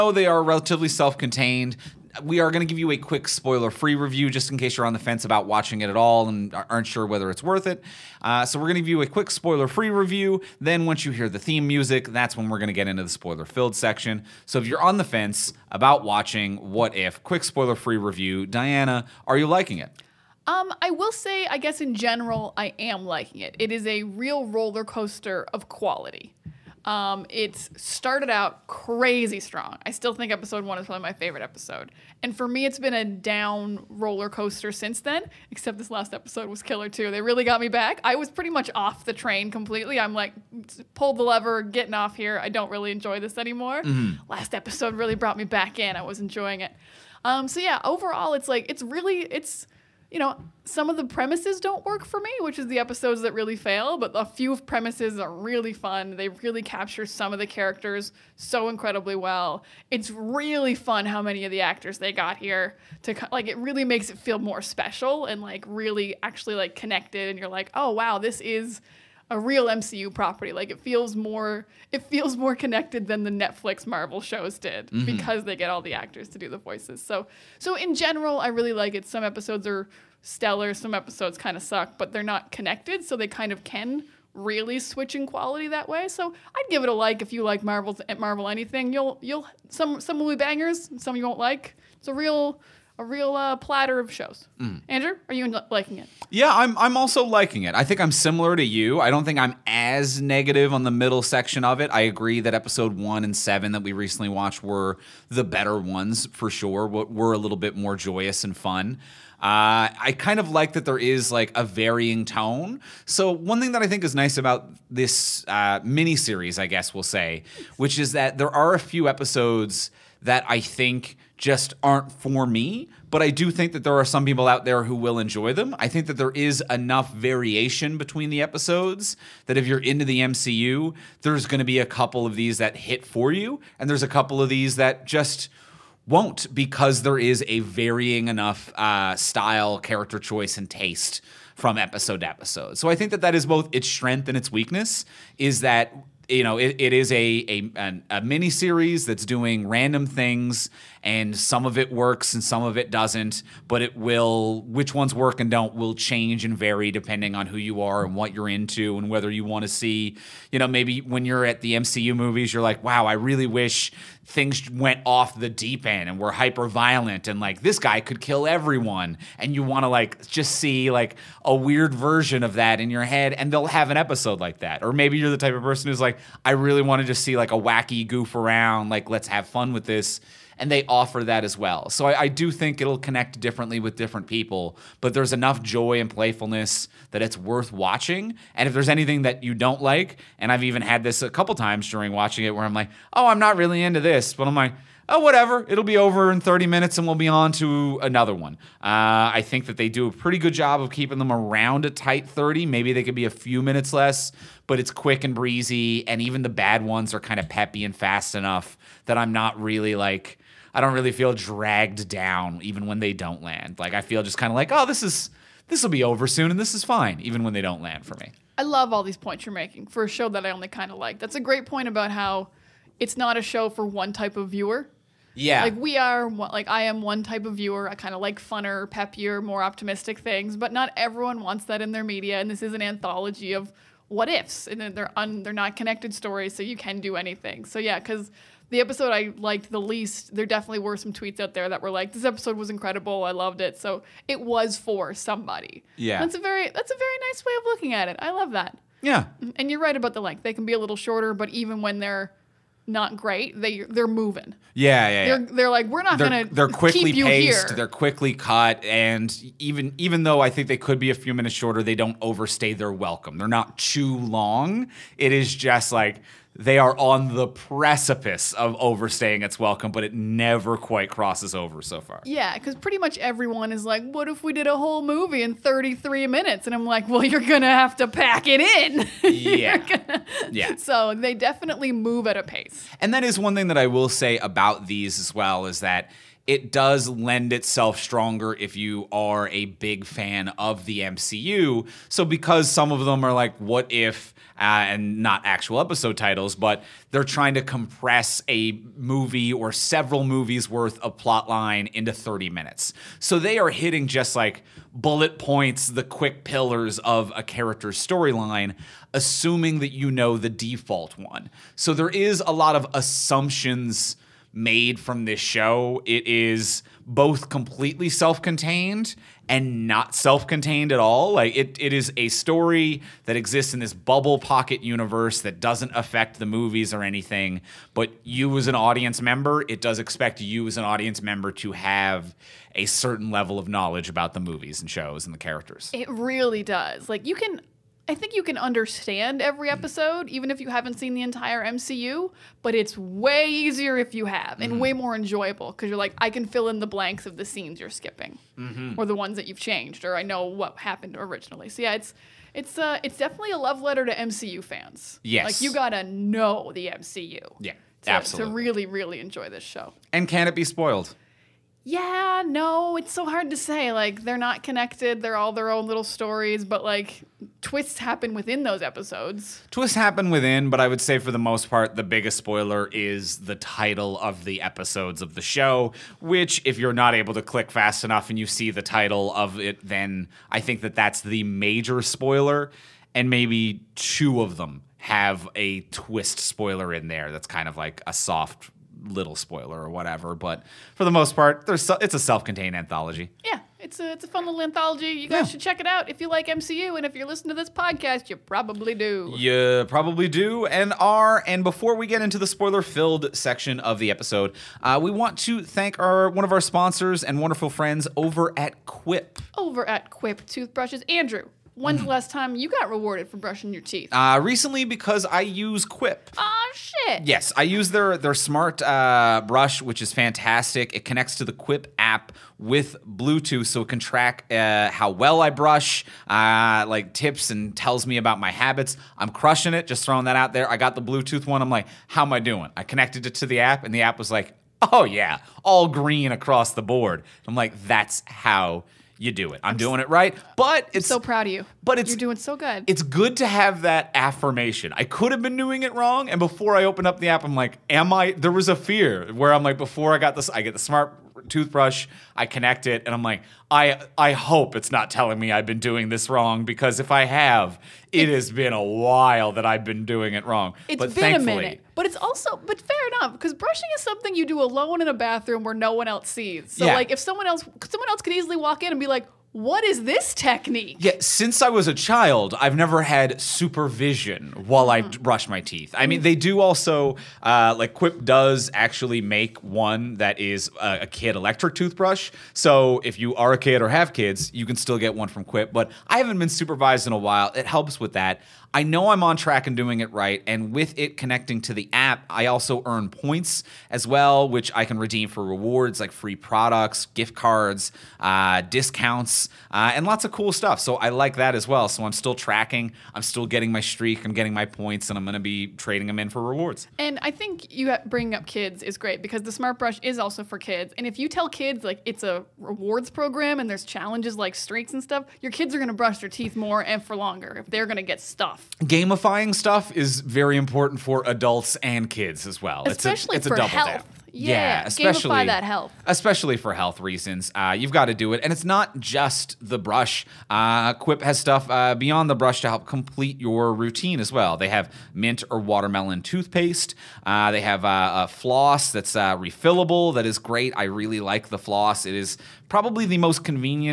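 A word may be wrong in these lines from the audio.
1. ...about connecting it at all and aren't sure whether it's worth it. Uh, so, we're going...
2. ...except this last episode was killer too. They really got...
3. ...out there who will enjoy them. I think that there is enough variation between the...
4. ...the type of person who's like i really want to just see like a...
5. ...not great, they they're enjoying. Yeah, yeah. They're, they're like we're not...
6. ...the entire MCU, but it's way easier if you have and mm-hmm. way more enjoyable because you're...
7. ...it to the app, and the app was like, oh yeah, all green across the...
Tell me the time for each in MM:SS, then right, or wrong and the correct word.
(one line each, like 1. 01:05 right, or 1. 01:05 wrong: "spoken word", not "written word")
1. 00:05 wrong: "watching", not "connecting"
2. 00:35 right
3. 02:04 right
4. 02:55 right
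5. 04:12 wrong: "moving", not "enjoying"
6. 05:41 right
7. 07:13 right.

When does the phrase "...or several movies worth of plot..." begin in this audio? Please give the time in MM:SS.
04:59.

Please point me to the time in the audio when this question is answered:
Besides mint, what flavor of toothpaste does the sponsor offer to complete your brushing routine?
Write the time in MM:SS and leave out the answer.
08:55.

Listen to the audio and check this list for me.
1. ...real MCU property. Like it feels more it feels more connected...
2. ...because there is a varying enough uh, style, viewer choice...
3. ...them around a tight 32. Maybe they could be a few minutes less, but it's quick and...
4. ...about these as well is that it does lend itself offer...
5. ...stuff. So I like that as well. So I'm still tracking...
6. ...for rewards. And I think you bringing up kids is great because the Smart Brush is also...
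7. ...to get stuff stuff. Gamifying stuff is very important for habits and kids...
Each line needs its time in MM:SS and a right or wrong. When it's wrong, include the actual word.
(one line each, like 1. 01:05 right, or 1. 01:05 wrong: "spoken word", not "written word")
1. 01:09 right
2. 02:16 wrong: "character", not "viewer"
3. 03:21 wrong: "30", not "32"
4. 04:44 wrong: "stronger", not "offer"
5. 08:20 right
6. 08:26 right
7. 08:37 wrong: "adults", not "habits".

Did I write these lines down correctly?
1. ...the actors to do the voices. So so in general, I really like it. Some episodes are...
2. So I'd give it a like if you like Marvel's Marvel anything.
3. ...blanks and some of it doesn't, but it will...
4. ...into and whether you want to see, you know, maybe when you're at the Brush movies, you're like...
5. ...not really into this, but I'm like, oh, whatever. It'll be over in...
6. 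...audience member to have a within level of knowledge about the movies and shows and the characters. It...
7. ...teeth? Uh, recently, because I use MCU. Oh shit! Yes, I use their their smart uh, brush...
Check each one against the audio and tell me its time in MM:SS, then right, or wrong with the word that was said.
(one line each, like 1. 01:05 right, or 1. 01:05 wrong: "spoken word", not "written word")
1. 01:15 right
2. 01:26 right
3. 02:31 wrong: "works", not "blanks"
4. 02:38 wrong: "MCU", not "Brush"
5. 03:13 right
6. 05:30 wrong: "certain", not "within"
7. 06:53 wrong: "Quip", not "MCU".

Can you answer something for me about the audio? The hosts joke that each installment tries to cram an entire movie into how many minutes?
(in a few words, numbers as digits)
33.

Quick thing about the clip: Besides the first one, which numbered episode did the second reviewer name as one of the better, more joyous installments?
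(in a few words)
Episode 7.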